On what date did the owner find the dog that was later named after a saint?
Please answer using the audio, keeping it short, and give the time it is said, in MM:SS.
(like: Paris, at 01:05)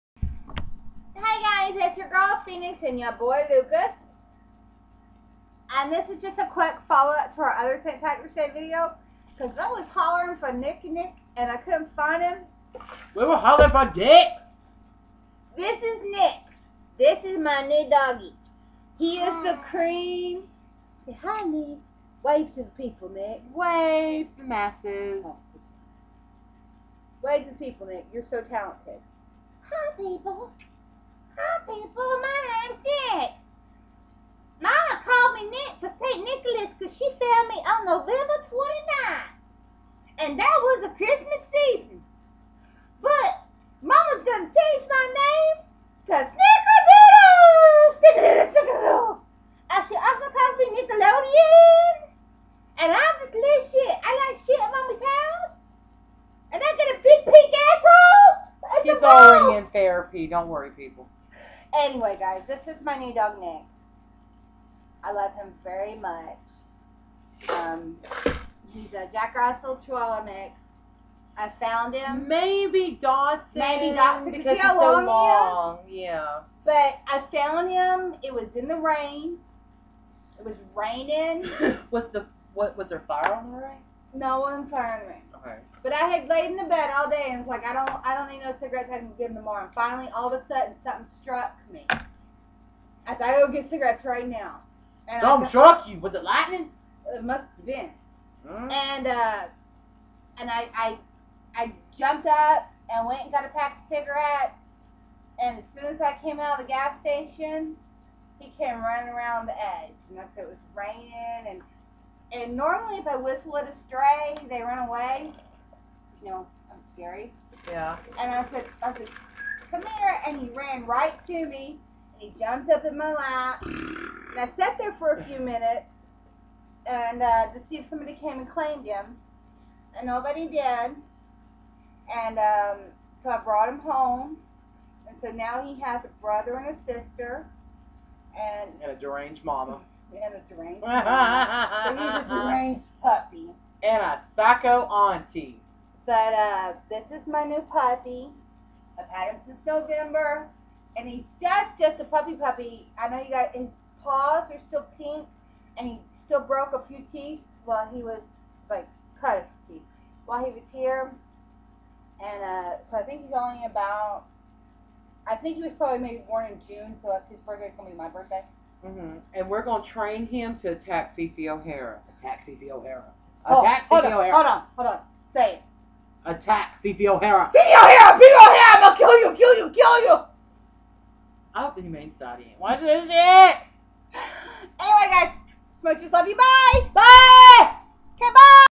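November 29th, at 00:37.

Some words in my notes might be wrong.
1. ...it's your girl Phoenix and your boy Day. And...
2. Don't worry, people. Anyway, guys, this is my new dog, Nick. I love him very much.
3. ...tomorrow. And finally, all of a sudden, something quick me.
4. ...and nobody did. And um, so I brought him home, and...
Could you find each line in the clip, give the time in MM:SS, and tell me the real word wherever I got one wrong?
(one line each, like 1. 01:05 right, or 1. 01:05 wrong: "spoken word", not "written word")
1. 00:01 wrong: "Lucas", not "Day"
2. 01:00 right
3. 01:29 wrong: "struck", not "quick"
4. 02:09 right.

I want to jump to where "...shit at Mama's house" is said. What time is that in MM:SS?
00:54.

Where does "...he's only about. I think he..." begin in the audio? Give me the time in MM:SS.
02:43.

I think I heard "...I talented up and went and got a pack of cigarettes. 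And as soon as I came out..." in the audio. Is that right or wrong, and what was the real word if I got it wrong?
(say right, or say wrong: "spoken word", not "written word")
wrong: "jumped", not "talented".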